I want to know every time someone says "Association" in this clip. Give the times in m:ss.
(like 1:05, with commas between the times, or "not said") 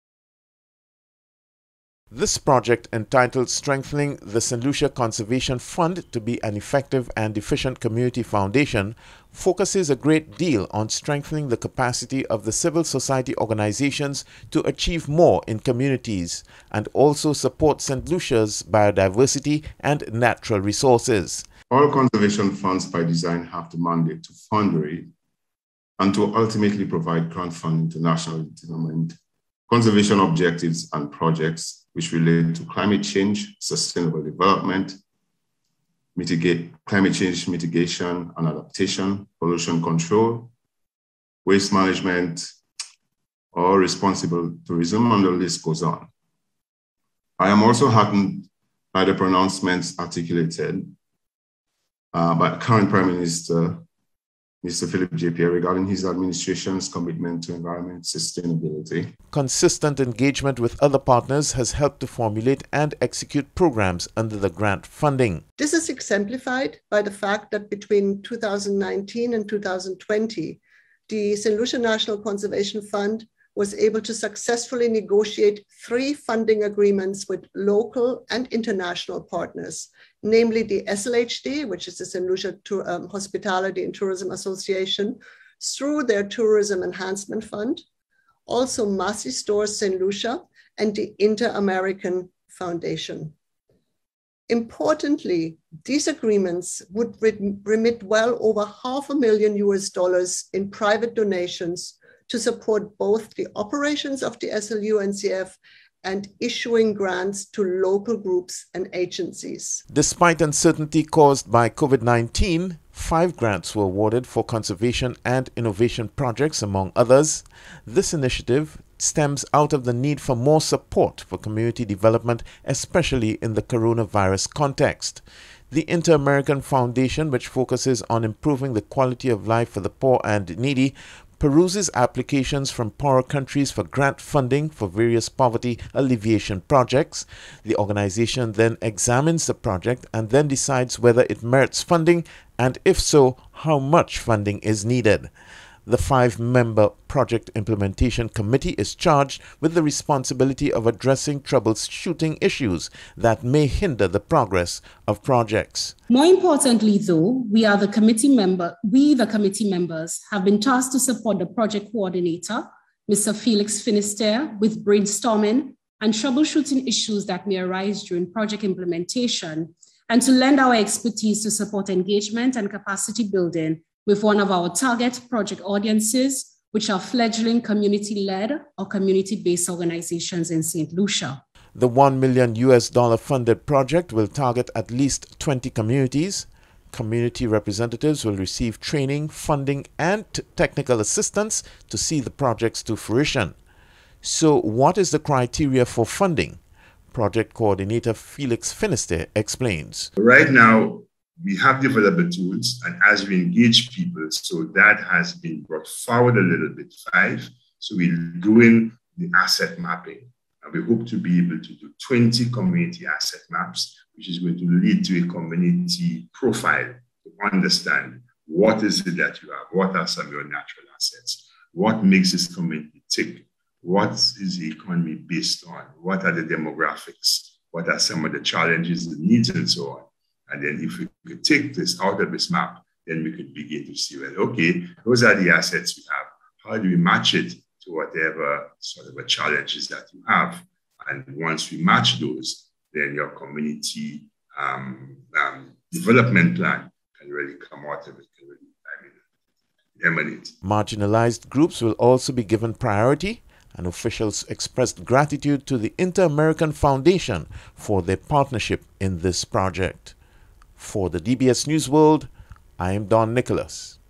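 1:24.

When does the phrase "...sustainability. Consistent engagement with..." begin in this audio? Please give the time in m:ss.
0:58.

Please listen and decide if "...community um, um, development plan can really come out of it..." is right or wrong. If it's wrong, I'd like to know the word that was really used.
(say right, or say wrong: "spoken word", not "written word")
right.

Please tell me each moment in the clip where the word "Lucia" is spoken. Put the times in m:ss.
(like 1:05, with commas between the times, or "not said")
0:04, 0:18, 1:11, 1:22, 1:29, 3:00.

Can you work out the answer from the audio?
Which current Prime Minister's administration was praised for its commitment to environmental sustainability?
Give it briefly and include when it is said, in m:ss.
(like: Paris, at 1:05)
Philip J. Pierre, at 0:54.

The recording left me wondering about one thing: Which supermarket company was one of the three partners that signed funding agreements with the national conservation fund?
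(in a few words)
Massy Stores.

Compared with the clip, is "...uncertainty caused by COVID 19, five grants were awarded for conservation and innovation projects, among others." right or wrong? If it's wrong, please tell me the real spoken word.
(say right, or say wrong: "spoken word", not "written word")
right.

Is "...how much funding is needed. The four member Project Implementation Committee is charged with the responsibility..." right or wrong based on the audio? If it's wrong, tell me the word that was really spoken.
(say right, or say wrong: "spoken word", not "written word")
wrong: "five", not "four".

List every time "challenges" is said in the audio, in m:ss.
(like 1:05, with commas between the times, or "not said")
3:48, 3:59.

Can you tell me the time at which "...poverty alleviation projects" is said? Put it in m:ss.
2:15.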